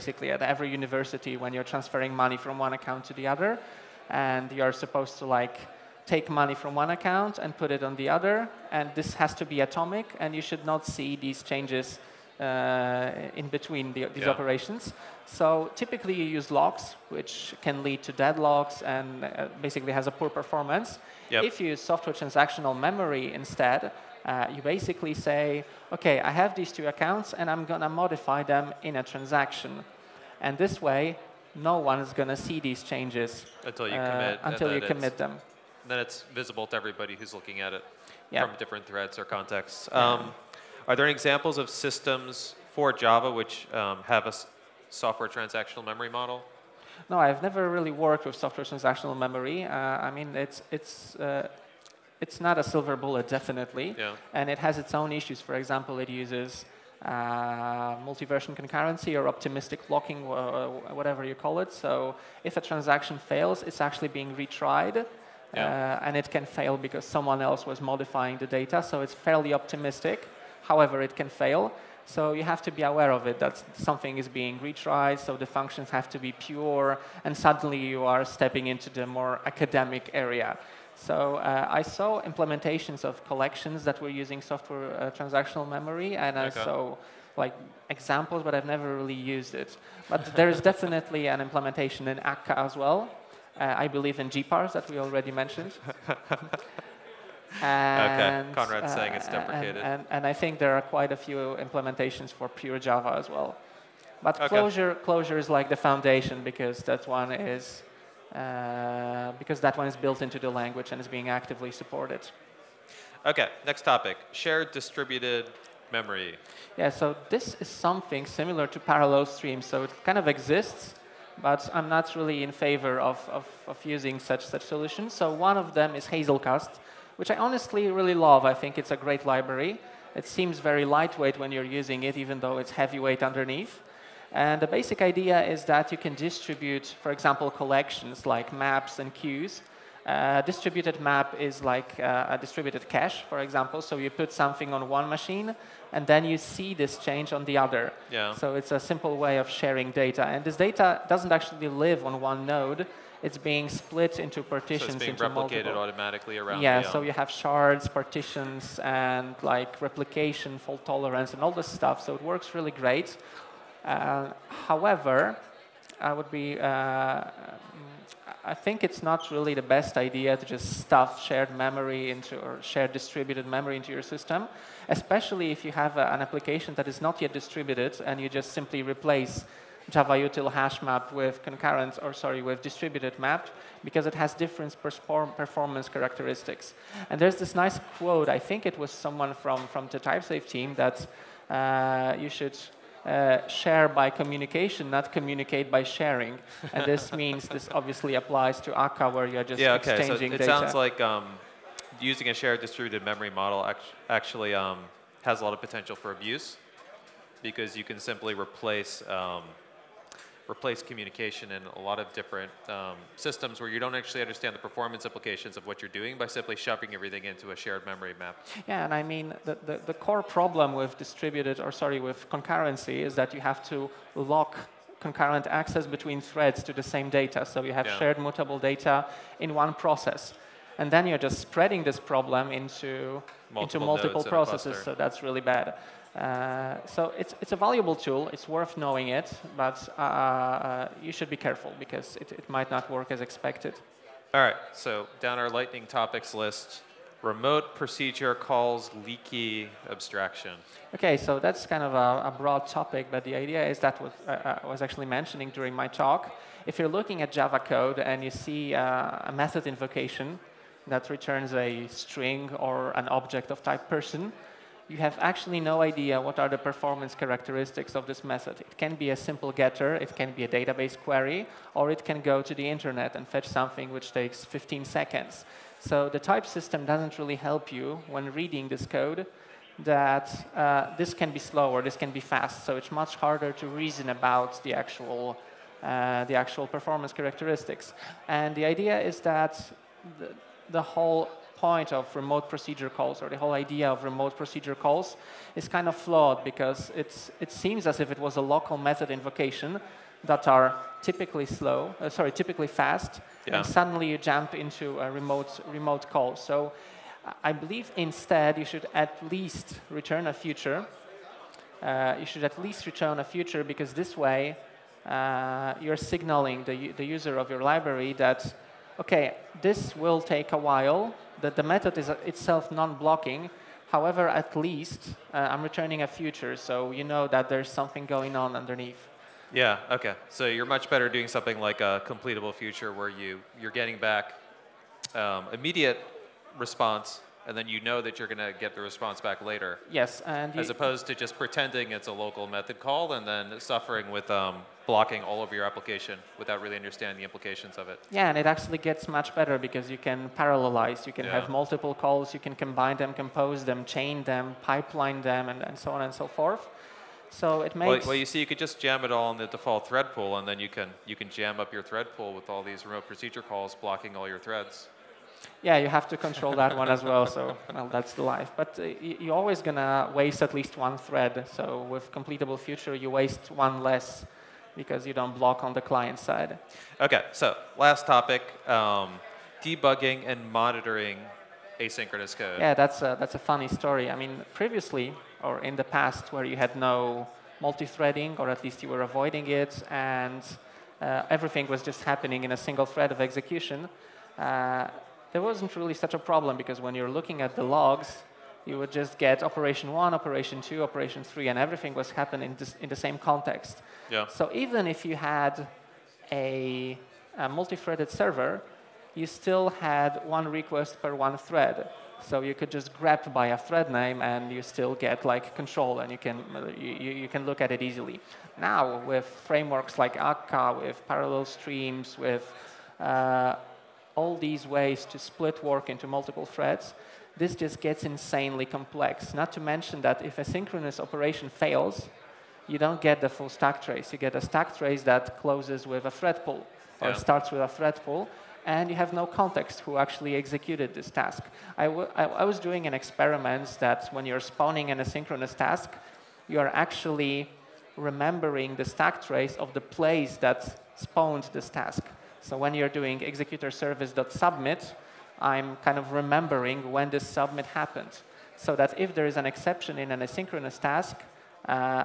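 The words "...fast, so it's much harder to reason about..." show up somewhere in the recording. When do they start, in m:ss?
4:42.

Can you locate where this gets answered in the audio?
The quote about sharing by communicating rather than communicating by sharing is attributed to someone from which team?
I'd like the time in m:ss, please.
3:09.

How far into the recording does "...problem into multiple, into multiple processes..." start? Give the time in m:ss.
3:52.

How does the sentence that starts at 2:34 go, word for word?
So it's being into replicated multiple.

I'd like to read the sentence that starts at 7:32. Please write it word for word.
So when you're doing executor service.submit, I'm kind of remembering when this submit happened.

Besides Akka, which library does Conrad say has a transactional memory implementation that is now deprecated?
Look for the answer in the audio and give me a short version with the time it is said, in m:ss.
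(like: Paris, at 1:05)
GPars, at 1:34.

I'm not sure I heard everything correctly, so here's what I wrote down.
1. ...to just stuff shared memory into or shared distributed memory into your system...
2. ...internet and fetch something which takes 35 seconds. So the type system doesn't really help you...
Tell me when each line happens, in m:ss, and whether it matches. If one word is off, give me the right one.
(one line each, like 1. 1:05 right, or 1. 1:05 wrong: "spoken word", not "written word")
1. 2:50 right
2. 4:32 wrong: "15", not "35".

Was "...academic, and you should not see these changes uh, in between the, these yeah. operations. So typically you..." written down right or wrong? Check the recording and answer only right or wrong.
wrong.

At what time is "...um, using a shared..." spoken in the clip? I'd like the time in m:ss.
3:21.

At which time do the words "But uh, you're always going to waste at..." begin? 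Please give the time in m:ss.
6:08.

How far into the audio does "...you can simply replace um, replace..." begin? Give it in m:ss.
3:27.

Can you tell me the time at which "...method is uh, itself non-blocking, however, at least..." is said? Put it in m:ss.
5:21.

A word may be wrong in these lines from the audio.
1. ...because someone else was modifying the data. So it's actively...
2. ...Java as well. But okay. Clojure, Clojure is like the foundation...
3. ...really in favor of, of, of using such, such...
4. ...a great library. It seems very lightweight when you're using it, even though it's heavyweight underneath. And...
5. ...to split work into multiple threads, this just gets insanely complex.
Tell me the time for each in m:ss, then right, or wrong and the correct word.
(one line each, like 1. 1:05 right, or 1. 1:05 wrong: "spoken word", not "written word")
1. 1:06 wrong: "fairly", not "actively"
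2. 1:42 right
3. 2:02 right
4. 2:08 right
5. 7:05 right.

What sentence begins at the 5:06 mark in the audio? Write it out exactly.
So I believe instead you should at least return a future.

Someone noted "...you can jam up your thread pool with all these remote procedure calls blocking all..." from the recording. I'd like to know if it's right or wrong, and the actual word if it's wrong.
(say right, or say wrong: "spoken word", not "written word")
right.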